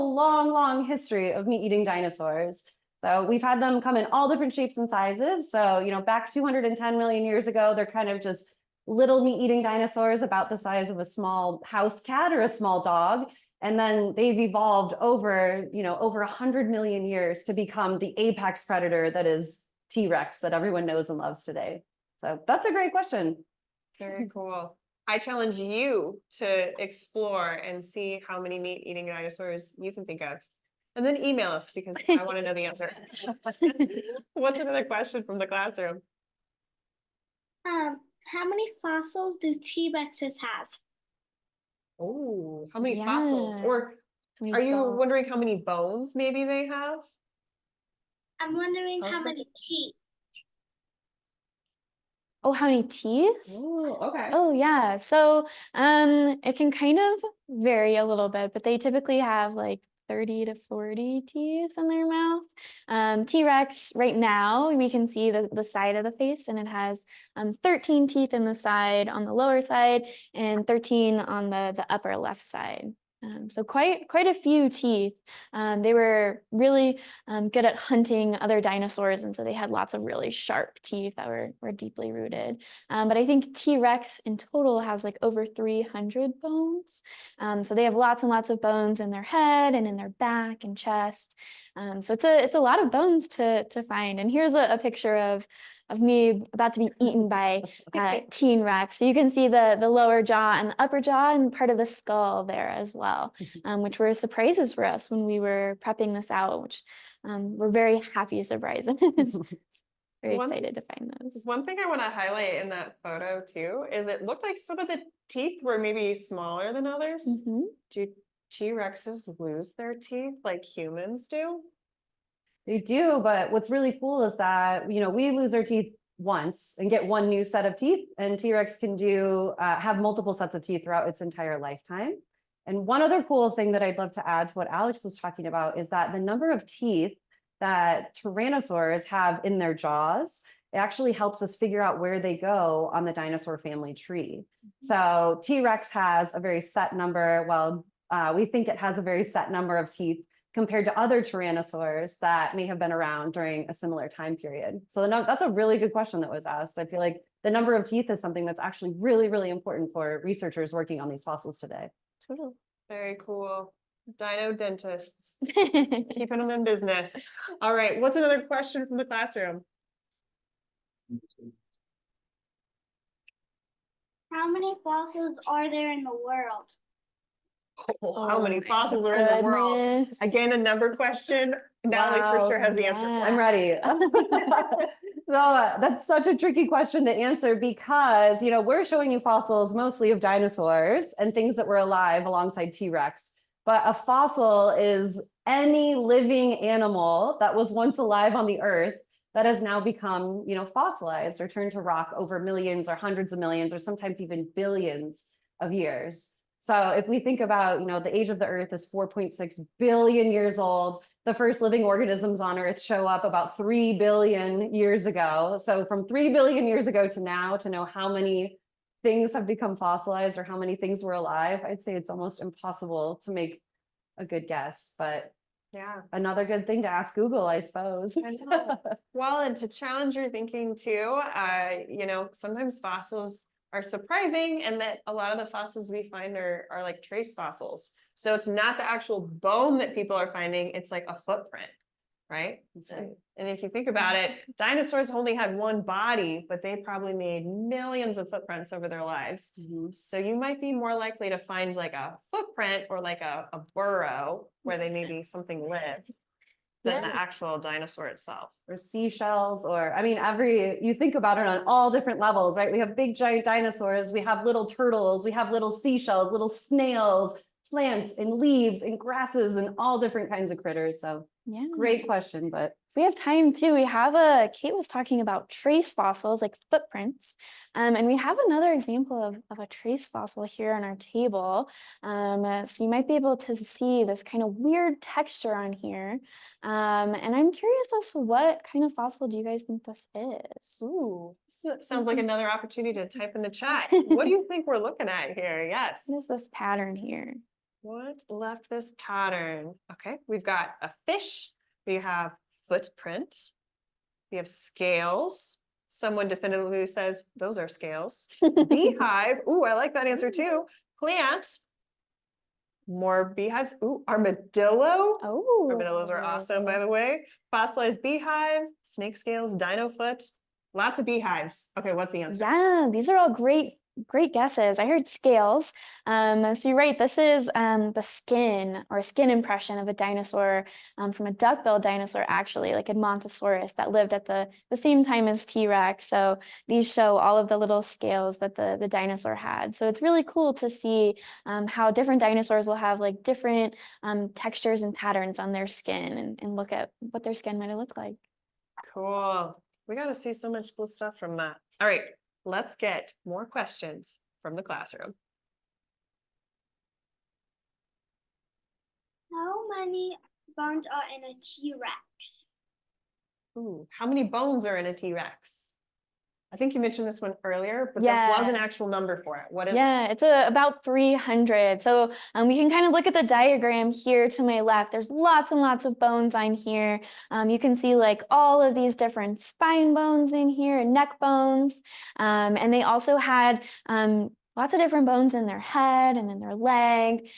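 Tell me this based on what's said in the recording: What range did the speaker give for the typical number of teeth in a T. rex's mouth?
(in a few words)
30 to 40.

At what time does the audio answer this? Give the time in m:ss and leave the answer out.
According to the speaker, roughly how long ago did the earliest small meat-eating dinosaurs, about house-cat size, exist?
0:06.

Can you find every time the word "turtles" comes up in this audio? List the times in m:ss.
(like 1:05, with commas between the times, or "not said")
4:24.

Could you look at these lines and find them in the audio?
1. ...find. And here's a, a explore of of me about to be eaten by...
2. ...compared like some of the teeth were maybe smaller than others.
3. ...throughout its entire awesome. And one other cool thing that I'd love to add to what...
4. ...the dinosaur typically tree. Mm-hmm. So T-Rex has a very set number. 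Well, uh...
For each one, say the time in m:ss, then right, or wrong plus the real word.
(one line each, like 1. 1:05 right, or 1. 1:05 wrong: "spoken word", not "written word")
1. 1:33 wrong: "picture", not "explore"
2. 1:54 wrong: "looked", not "compared"
3. 2:10 wrong: "lifetime", not "awesome"
4. 2:23 wrong: "family", not "typically".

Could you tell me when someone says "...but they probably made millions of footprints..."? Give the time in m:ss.
4:06.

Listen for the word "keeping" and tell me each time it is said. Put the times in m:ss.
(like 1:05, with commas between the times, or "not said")
2:45.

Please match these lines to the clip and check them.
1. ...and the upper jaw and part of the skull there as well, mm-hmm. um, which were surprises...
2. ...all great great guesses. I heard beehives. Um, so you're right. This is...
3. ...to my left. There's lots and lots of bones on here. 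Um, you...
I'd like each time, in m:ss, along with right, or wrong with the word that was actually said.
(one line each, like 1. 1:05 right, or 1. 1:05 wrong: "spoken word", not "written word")
1. 1:40 right
2. 5:23 wrong: "scales", not "beehives"
3. 6:14 right.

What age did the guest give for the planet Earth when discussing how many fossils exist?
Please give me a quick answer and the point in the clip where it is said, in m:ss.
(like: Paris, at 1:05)
4.6 billion years, at 3:28.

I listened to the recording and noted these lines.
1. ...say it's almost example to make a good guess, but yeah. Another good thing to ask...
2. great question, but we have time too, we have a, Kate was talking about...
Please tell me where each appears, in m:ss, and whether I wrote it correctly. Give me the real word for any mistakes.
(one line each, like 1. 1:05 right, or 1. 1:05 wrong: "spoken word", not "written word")
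1. 3:41 wrong: "impossible", not "example"
2. 4:31 right.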